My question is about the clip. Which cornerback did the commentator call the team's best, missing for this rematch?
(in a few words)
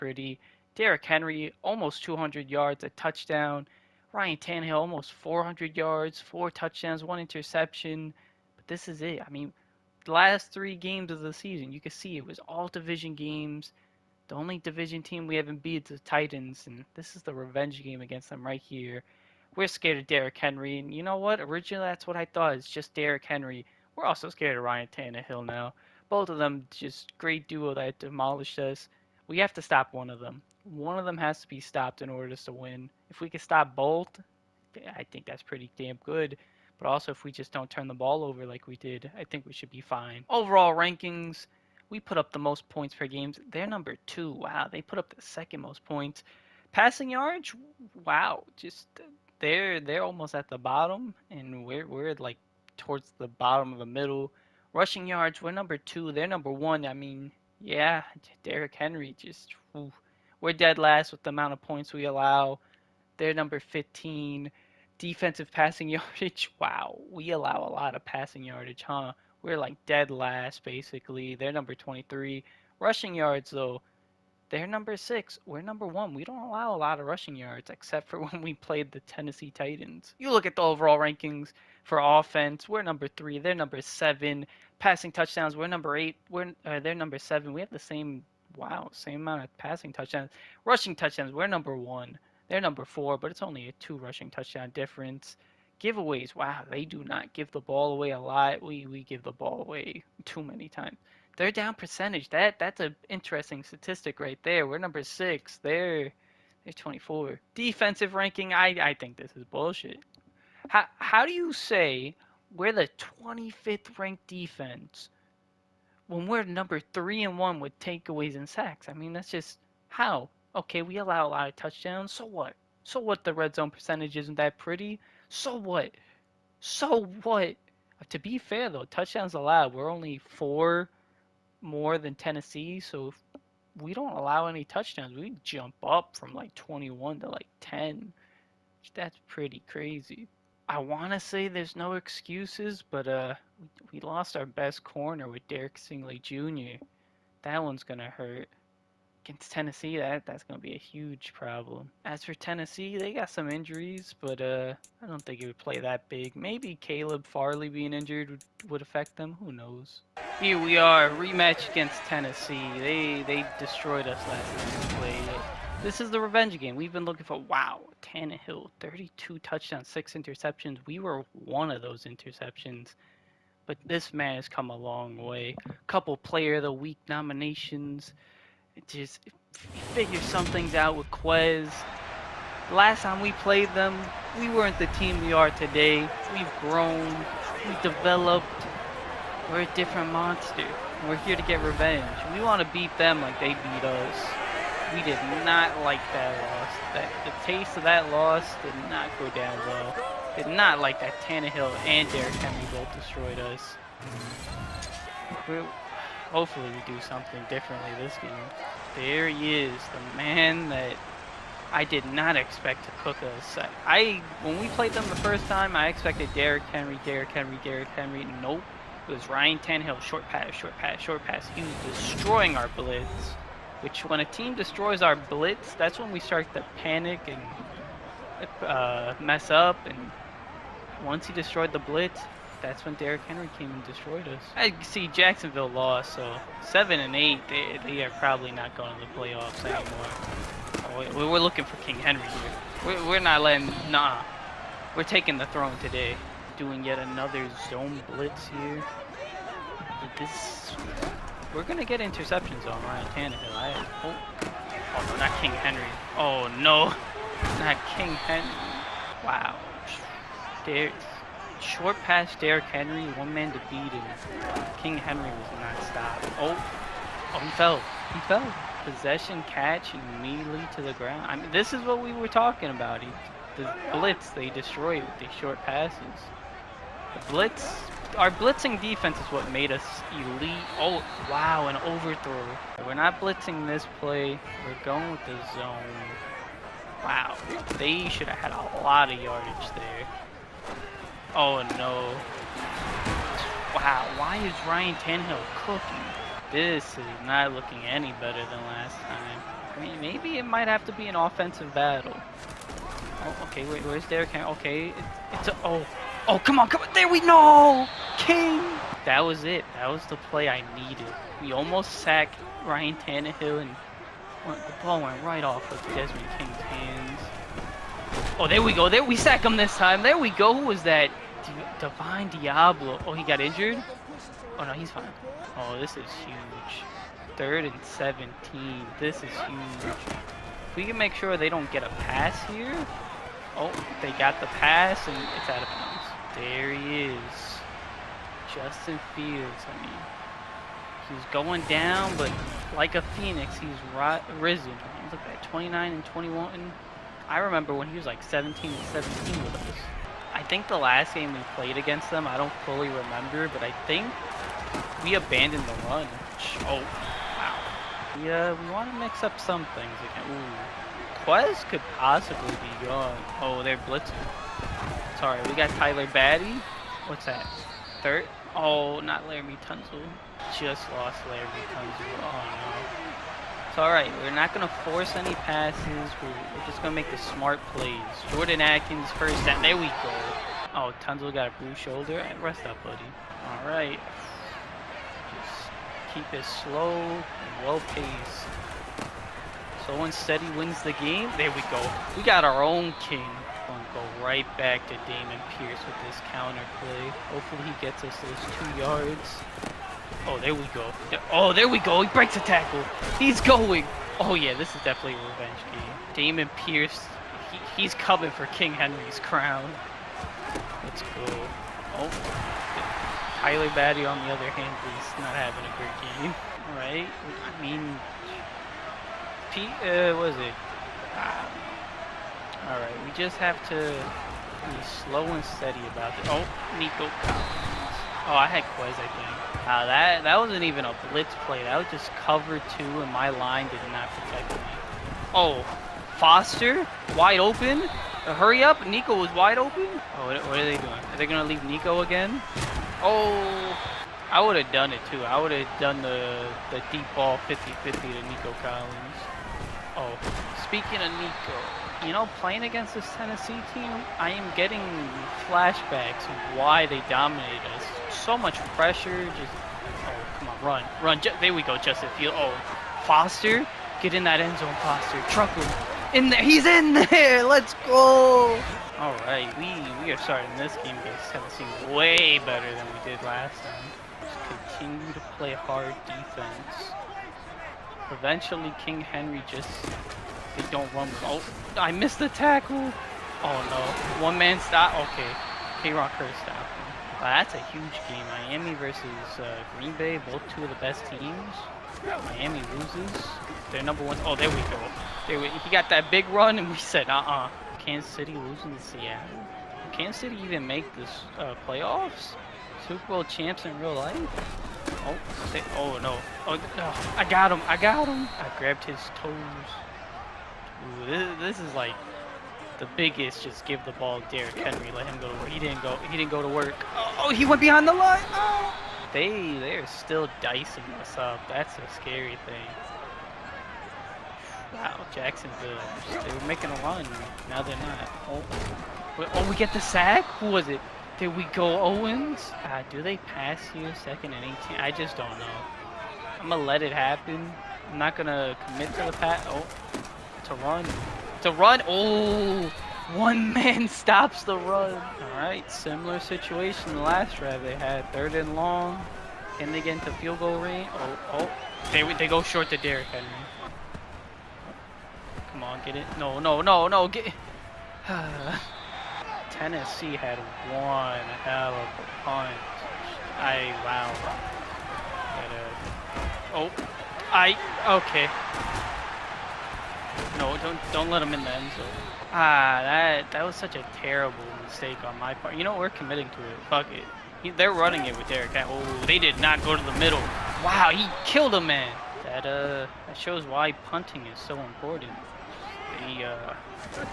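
Derek Stingley Jr.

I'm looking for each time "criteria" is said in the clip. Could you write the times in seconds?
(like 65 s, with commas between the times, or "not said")
not said.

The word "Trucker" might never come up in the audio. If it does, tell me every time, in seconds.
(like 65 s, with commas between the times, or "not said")
465 s.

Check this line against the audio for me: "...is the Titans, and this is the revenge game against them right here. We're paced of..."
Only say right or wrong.
wrong.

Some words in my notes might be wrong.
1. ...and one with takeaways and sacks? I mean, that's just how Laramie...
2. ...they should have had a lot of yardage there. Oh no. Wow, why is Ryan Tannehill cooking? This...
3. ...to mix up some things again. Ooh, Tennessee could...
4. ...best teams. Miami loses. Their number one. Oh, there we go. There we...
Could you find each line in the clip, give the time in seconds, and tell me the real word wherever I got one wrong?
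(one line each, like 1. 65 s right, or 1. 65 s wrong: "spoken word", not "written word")
1. 117 s wrong: "Okay", not "Laramie"
2. 287 s right
3. 358 s wrong: "Quez", not "Tennessee"
4. 490 s right.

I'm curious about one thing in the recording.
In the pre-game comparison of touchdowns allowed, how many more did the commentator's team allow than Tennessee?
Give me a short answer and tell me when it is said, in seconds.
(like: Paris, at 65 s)
4, at 130 s.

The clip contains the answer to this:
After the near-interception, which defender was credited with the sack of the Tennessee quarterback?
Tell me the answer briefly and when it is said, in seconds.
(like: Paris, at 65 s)
Divine Deablo, at 321 s.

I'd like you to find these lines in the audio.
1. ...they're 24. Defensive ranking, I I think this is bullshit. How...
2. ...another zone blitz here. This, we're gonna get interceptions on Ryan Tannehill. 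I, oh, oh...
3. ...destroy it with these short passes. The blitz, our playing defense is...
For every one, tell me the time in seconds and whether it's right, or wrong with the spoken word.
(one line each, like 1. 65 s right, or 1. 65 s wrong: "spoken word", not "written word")
1. 106 s right
2. 246 s right
3. 274 s wrong: "blitzing", not "playing".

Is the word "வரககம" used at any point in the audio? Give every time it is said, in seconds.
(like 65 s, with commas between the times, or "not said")
not said.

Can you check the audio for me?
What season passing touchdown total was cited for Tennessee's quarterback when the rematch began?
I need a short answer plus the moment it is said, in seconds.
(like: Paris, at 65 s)
32, at 168 s.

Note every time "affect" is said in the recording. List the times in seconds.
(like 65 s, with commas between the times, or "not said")
158 s.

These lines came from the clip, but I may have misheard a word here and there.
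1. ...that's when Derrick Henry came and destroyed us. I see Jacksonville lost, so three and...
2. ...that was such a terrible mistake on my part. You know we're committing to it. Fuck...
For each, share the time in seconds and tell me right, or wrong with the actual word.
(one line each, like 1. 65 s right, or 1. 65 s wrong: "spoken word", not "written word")
1. 232 s wrong: "seven", not "three"
2. 573 s right.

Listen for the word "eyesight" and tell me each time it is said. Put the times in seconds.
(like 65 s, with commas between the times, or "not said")
not said.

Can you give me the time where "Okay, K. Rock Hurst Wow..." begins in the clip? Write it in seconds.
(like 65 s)
484 s.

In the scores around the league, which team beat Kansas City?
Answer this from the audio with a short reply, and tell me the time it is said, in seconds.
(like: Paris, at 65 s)
Seattle, at 498 s.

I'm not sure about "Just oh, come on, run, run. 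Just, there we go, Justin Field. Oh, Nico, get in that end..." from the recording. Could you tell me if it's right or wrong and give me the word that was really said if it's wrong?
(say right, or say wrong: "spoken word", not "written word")
wrong: "Foster", not "Nico".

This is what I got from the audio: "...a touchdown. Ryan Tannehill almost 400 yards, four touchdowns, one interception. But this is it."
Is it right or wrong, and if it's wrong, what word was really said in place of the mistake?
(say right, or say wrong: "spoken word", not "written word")
right.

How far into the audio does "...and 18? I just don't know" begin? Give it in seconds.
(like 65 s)
534 s.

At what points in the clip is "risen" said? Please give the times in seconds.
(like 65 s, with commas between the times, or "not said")
344 s.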